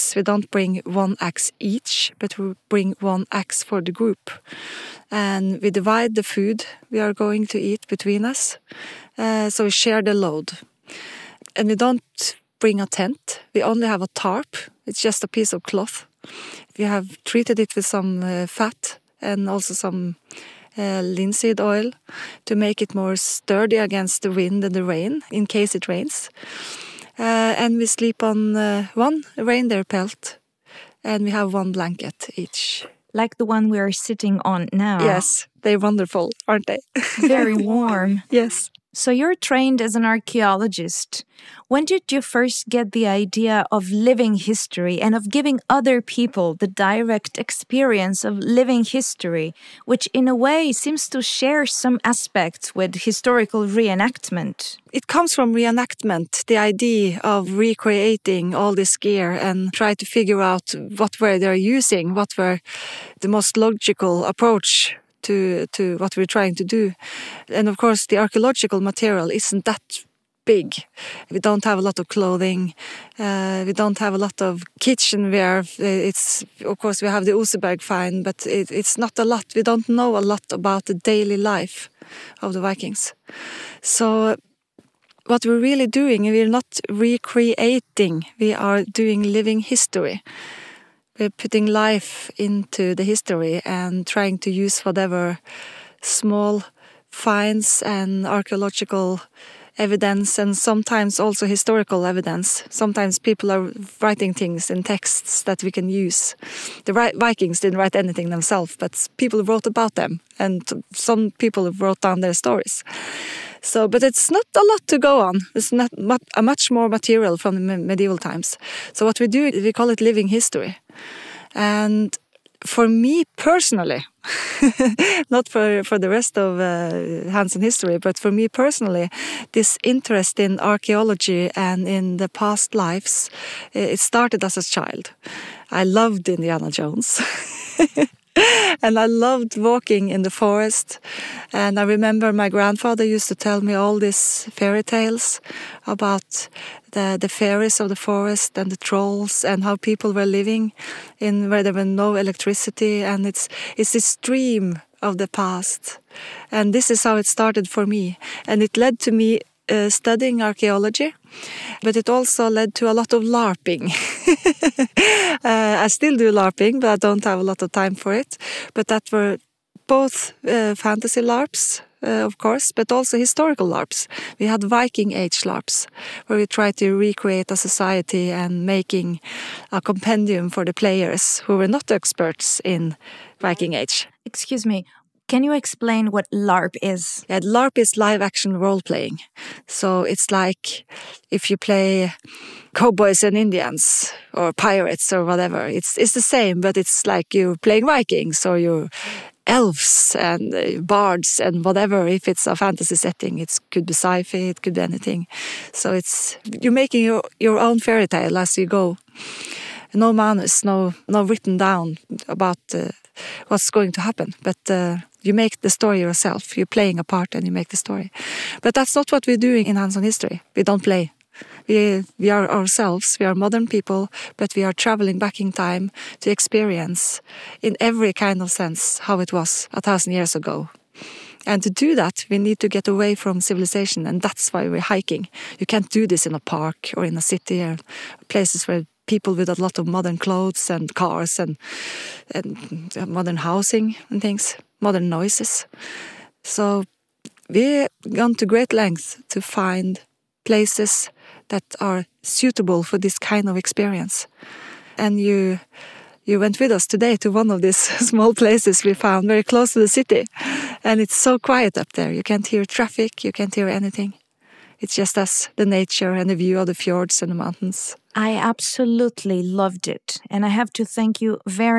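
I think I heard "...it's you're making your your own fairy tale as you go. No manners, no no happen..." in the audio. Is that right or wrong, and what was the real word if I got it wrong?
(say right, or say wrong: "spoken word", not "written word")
wrong: "written", not "happen".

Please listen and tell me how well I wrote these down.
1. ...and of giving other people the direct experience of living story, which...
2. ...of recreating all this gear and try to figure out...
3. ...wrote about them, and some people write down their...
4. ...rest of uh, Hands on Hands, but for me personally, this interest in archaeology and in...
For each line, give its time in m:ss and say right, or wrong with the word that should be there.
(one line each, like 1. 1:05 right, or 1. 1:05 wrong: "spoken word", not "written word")
1. 0:45 wrong: "history", not "story"
2. 0:57 right
3. 1:49 wrong: "wrote", not "write"
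4. 2:06 wrong: "History", not "Hands".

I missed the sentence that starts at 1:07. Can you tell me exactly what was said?
And of course, the archaeological material isn't that big.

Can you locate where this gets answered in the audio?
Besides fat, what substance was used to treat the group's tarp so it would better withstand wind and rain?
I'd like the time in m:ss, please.
0:21.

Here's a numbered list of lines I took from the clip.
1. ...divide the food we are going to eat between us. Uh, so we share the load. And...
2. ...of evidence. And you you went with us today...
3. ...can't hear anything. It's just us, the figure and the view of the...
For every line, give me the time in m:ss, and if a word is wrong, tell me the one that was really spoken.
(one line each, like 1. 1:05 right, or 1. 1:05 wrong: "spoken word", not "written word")
1. 0:05 right
2. 4:13 wrong: "experience", not "evidence"
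3. 4:23 wrong: "nature", not "figure".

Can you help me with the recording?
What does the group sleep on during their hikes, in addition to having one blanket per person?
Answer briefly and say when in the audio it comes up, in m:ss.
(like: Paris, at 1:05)
reindeer pelt, at 0:29.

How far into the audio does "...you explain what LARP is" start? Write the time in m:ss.
3:05.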